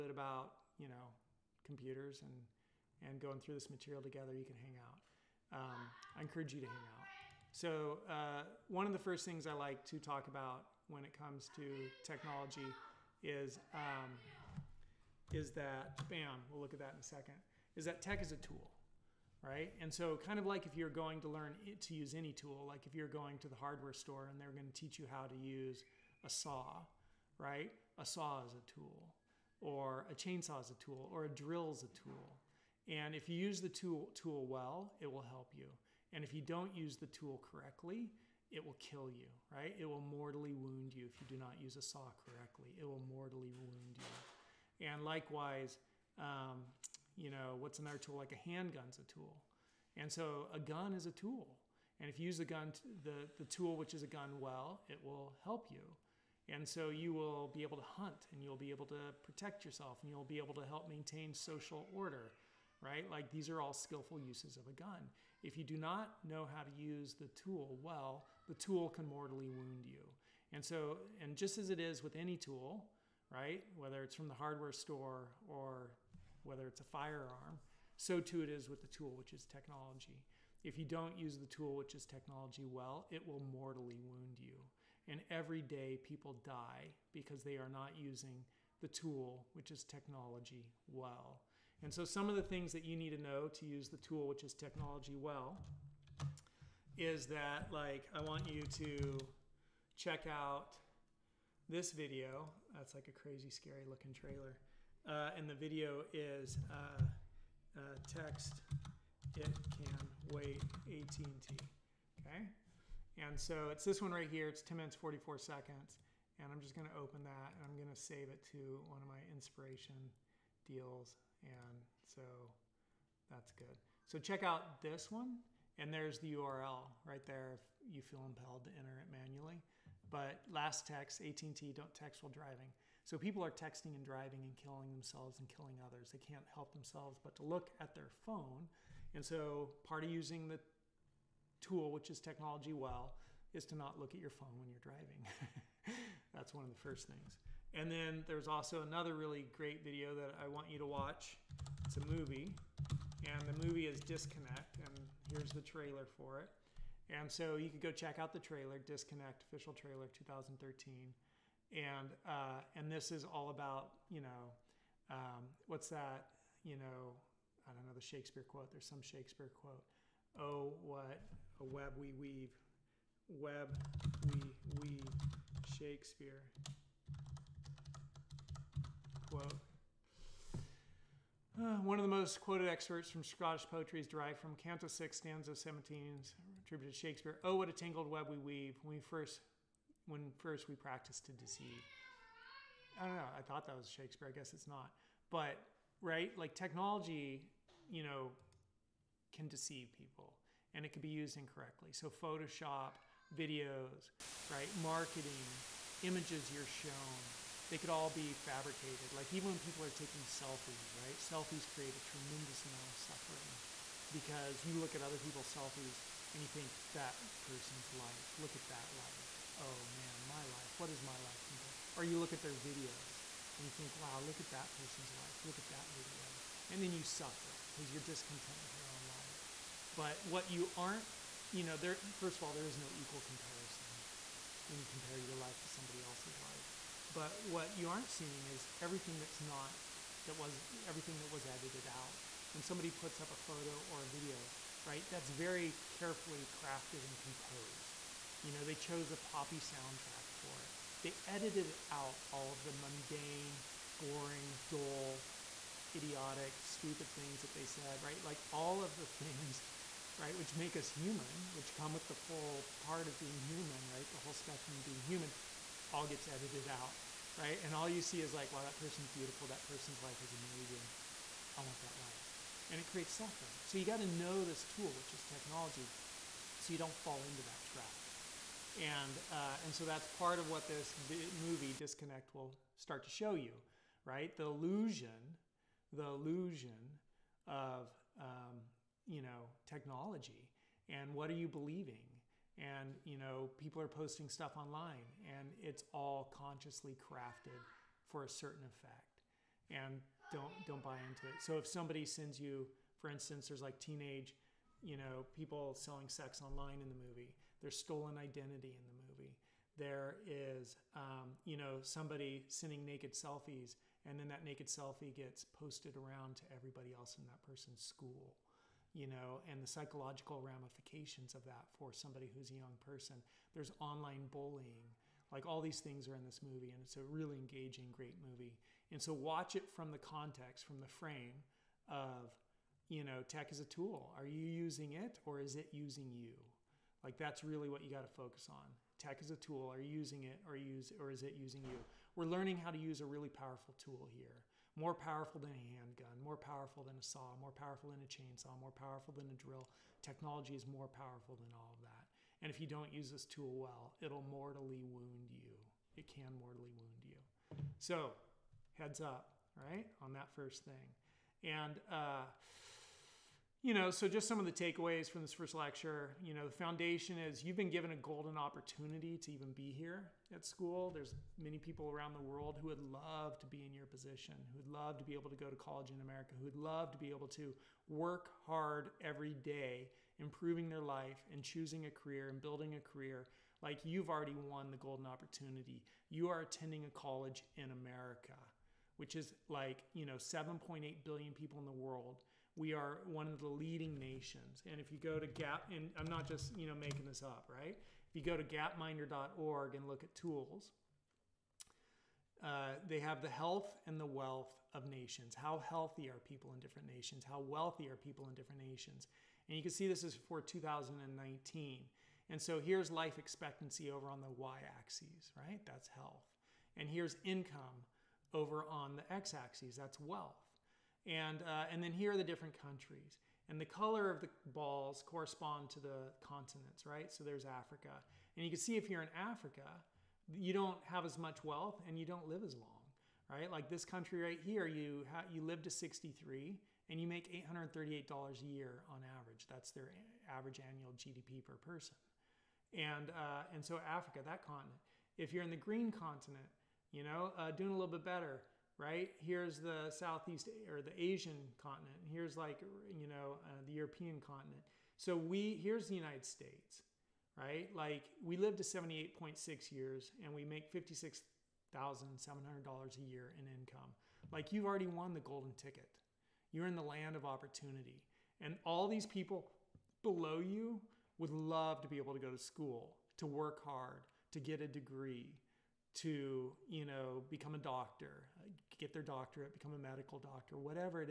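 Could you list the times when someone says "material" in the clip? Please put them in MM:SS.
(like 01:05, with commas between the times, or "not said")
00:03.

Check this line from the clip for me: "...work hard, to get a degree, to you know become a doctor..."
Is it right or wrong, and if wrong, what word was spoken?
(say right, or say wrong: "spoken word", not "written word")
right.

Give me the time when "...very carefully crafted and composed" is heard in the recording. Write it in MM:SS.
04:05.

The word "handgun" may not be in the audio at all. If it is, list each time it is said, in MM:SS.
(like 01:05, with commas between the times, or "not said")
00:48, 05:45.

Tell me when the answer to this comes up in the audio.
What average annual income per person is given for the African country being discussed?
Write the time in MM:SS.
07:17.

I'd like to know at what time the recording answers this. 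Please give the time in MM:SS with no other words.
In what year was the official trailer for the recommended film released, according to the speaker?
02:40.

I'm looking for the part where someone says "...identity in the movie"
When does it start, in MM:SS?
05:08.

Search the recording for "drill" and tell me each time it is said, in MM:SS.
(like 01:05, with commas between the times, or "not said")
00:31, 05:49.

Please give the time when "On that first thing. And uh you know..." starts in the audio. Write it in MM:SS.
06:00.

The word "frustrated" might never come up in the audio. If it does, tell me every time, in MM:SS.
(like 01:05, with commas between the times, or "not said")
not said.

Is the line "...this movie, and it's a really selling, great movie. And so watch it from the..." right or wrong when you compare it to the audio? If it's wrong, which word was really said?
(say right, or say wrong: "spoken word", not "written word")
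wrong: "engaging", not "selling".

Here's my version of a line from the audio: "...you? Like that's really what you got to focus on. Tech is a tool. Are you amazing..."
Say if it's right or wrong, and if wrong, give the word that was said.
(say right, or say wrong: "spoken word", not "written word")
wrong: "using", not "amazing".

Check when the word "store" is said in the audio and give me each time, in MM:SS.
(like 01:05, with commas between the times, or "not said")
00:23, 01:14.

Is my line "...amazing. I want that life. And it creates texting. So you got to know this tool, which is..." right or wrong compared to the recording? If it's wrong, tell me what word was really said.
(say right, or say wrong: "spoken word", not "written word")
wrong: "suffering", not "texting".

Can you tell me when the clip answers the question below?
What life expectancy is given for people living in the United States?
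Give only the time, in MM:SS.
07:38.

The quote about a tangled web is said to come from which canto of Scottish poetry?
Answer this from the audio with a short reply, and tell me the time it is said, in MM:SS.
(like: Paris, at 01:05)
Canto 6, at 03:04.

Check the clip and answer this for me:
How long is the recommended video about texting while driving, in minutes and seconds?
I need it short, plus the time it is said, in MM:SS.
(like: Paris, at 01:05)
10 minutes, 44 seconds, at 01:54.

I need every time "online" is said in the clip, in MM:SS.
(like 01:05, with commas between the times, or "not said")
04:54, 05:06, 05:23.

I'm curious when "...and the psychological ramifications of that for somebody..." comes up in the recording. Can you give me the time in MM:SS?
05:19.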